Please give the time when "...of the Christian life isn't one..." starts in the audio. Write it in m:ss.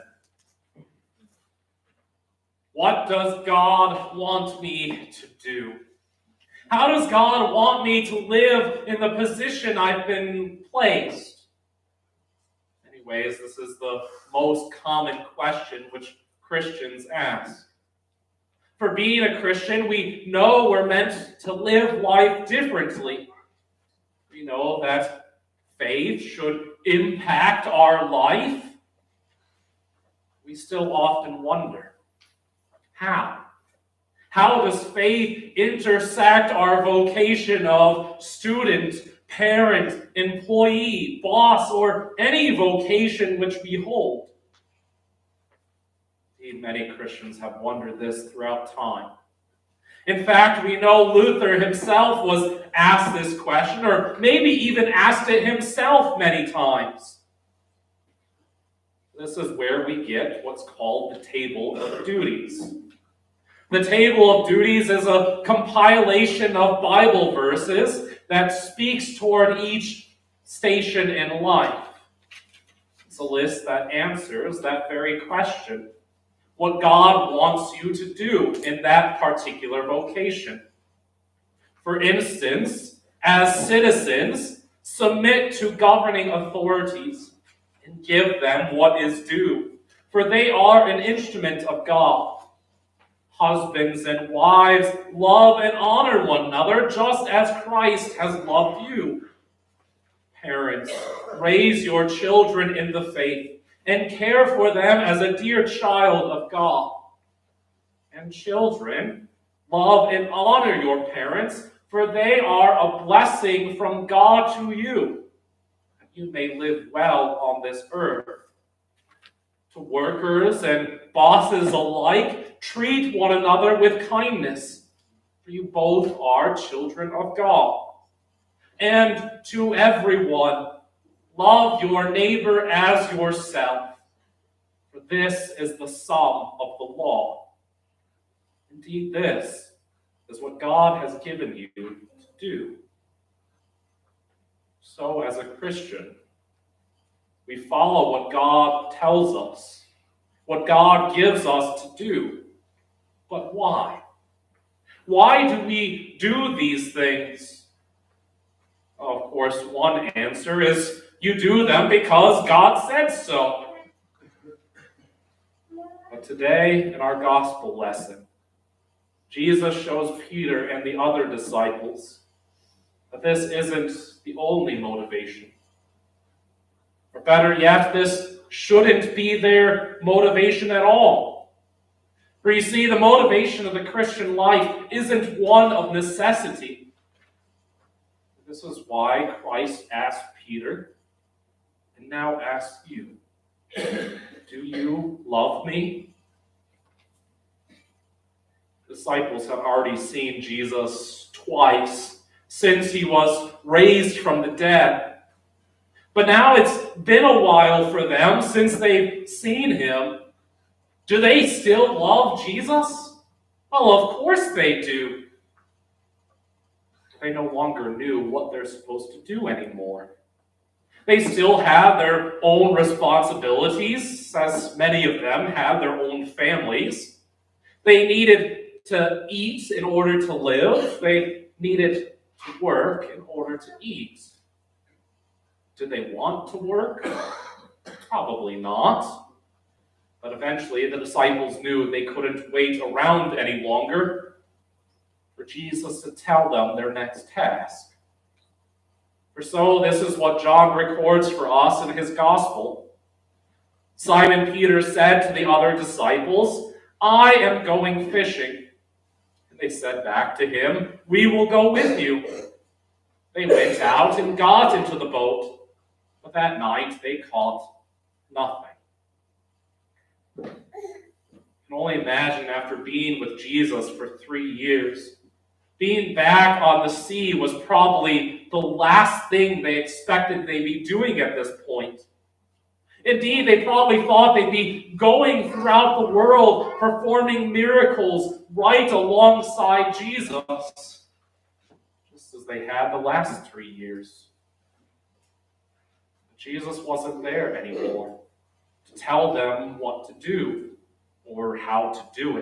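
3:03.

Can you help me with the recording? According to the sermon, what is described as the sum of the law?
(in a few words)
Love your neighbor as yourself.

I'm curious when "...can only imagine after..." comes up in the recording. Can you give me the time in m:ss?
4:30.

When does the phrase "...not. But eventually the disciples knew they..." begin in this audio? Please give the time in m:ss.
3:58.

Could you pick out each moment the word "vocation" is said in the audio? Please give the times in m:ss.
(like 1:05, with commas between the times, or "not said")
0:36, 0:42, 1:19.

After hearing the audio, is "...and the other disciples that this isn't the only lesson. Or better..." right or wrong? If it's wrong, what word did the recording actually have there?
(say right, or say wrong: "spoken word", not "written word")
wrong: "motivation", not "lesson".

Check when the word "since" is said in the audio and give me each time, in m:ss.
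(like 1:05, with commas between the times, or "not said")
3:22, 3:28.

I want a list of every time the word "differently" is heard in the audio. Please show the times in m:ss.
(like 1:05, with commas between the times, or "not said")
0:22.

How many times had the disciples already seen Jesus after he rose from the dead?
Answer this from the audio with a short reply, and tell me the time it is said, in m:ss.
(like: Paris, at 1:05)
2, at 3:21.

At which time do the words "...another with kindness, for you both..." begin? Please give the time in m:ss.
2:03.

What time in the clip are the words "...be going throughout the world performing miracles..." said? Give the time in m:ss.
4:44.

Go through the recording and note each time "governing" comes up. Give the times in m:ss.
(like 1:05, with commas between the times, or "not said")
1:25.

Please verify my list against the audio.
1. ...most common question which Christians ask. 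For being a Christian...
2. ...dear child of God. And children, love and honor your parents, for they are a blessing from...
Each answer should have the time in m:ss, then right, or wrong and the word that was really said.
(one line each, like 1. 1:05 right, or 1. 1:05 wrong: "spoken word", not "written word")
1. 0:14 right
2. 1:45 right.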